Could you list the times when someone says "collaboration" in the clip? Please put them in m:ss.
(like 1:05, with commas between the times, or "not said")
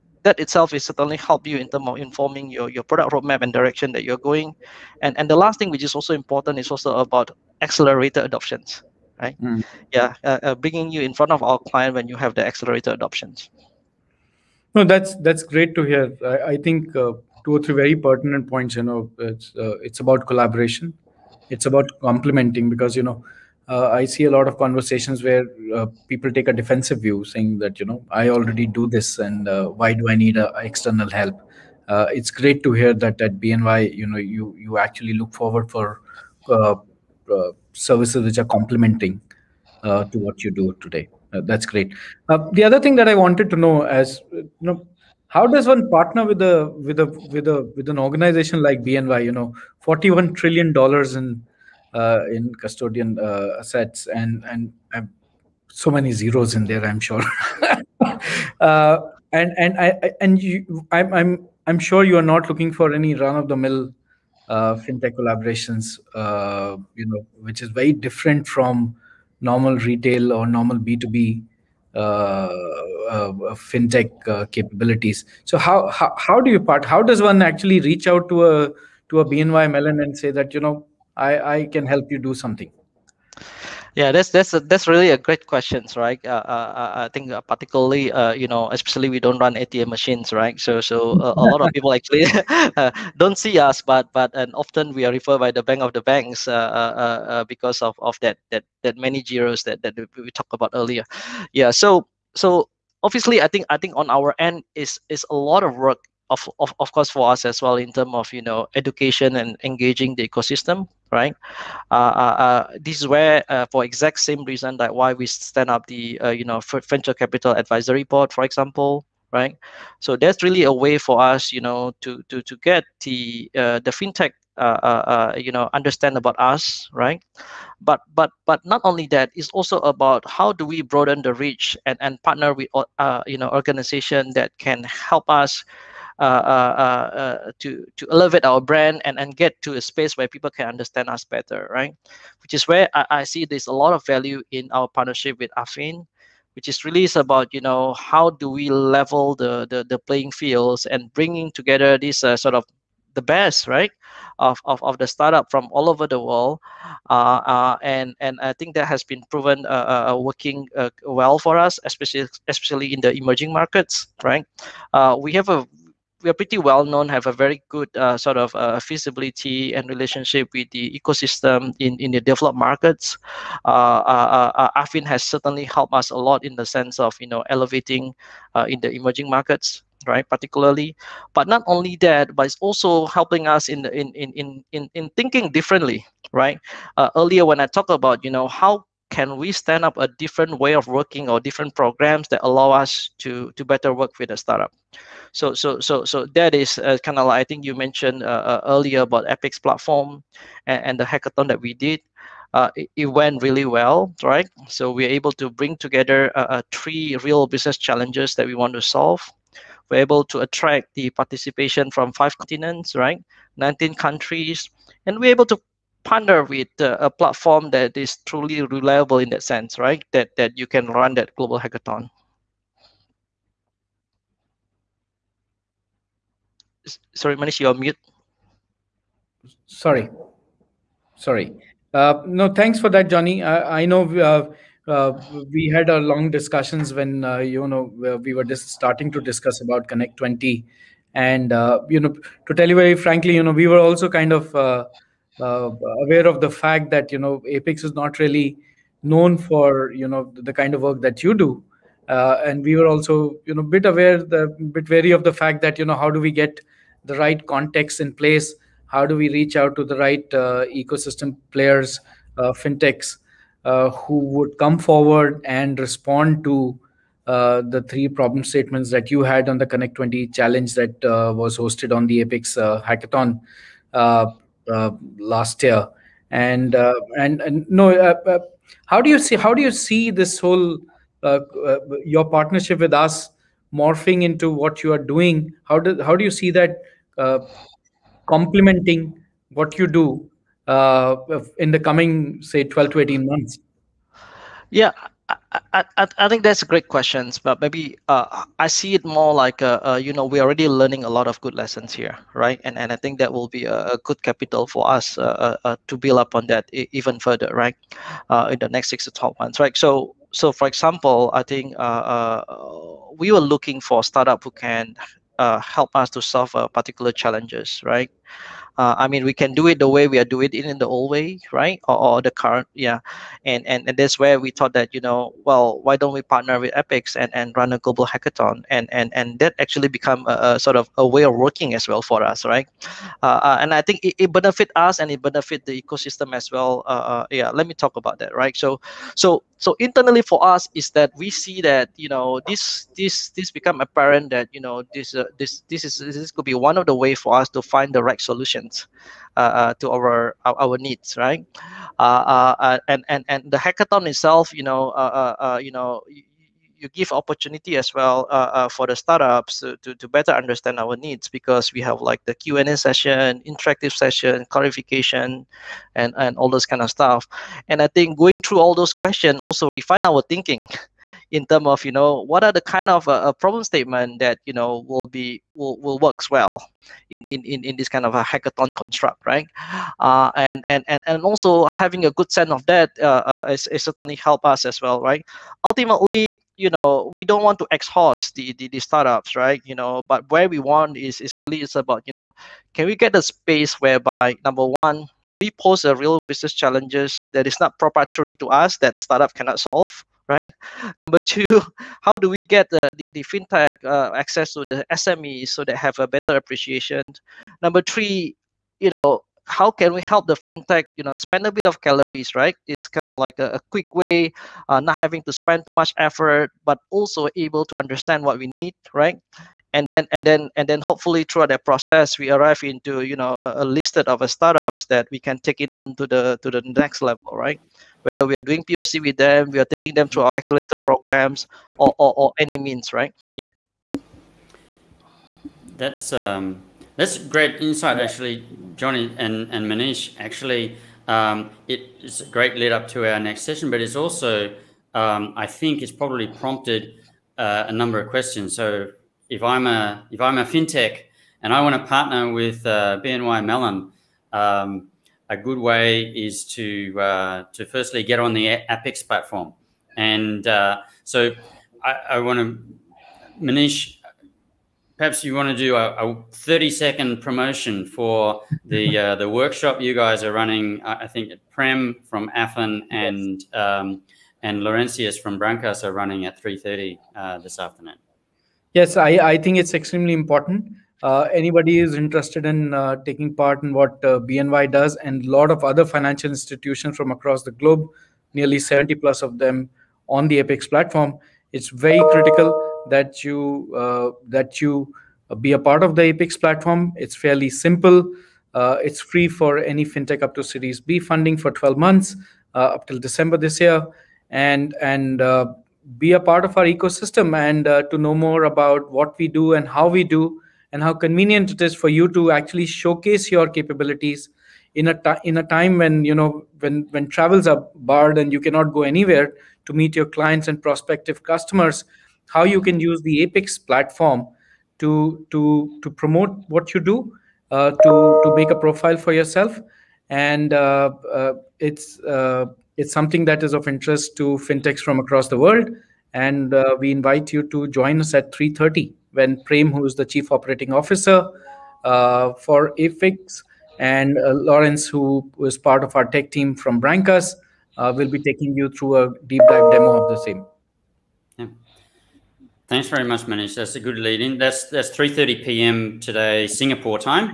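0:20, 1:05.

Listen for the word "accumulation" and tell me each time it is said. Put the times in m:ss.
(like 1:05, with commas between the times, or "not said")
not said.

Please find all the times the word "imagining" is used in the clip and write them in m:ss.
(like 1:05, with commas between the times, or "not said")
not said.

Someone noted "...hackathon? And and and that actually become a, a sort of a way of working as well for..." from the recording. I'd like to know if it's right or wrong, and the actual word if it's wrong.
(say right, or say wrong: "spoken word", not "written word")
right.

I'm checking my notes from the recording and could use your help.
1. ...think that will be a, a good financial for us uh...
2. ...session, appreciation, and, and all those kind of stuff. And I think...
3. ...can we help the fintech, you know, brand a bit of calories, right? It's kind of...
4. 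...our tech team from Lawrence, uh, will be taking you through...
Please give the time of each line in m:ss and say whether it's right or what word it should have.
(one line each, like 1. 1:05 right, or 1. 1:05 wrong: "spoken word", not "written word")
1. 5:02 wrong: "capital", not "financial"
2. 6:03 wrong: "clarification", not "appreciation"
3. 6:49 wrong: "spend", not "brand"
4. 9:05 wrong: "Brankas", not "Lawrence".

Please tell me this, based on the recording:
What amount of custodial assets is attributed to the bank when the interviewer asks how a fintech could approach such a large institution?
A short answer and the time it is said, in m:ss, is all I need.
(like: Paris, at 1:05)
41 trillion dollars, at 0:49.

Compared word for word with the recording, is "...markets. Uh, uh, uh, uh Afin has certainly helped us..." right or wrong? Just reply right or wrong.
right.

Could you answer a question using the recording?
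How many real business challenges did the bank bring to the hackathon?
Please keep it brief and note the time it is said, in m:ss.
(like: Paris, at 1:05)
3, at 3:26.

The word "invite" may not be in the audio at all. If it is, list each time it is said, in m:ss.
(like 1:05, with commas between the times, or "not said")
8:56.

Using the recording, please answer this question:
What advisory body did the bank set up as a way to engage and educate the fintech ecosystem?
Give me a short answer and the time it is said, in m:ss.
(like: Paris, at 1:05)
venture capital advisory board, at 1:56.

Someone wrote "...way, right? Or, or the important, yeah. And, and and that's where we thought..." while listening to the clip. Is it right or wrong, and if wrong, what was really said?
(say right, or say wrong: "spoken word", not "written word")
wrong: "current", not "important".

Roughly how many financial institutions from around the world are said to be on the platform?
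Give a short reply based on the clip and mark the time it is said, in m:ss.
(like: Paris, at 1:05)
70 plus, at 8:08.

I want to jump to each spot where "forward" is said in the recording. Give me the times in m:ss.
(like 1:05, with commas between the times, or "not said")
0:35, 4:24.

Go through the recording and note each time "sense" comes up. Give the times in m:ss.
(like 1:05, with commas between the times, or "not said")
2:56, 3:39, 6:22.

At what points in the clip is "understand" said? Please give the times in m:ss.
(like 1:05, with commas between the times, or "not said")
2:05, 2:20, 6:00, 6:57.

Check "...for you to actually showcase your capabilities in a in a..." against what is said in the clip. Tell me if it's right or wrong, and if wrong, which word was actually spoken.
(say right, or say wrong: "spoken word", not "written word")
right.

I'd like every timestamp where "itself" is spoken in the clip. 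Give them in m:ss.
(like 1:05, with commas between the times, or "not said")
0:00, 5:54.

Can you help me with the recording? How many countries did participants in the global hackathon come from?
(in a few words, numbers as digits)
19.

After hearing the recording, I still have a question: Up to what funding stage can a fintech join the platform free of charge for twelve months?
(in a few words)
Series B.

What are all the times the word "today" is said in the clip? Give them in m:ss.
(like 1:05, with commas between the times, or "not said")
0:40, 9:15.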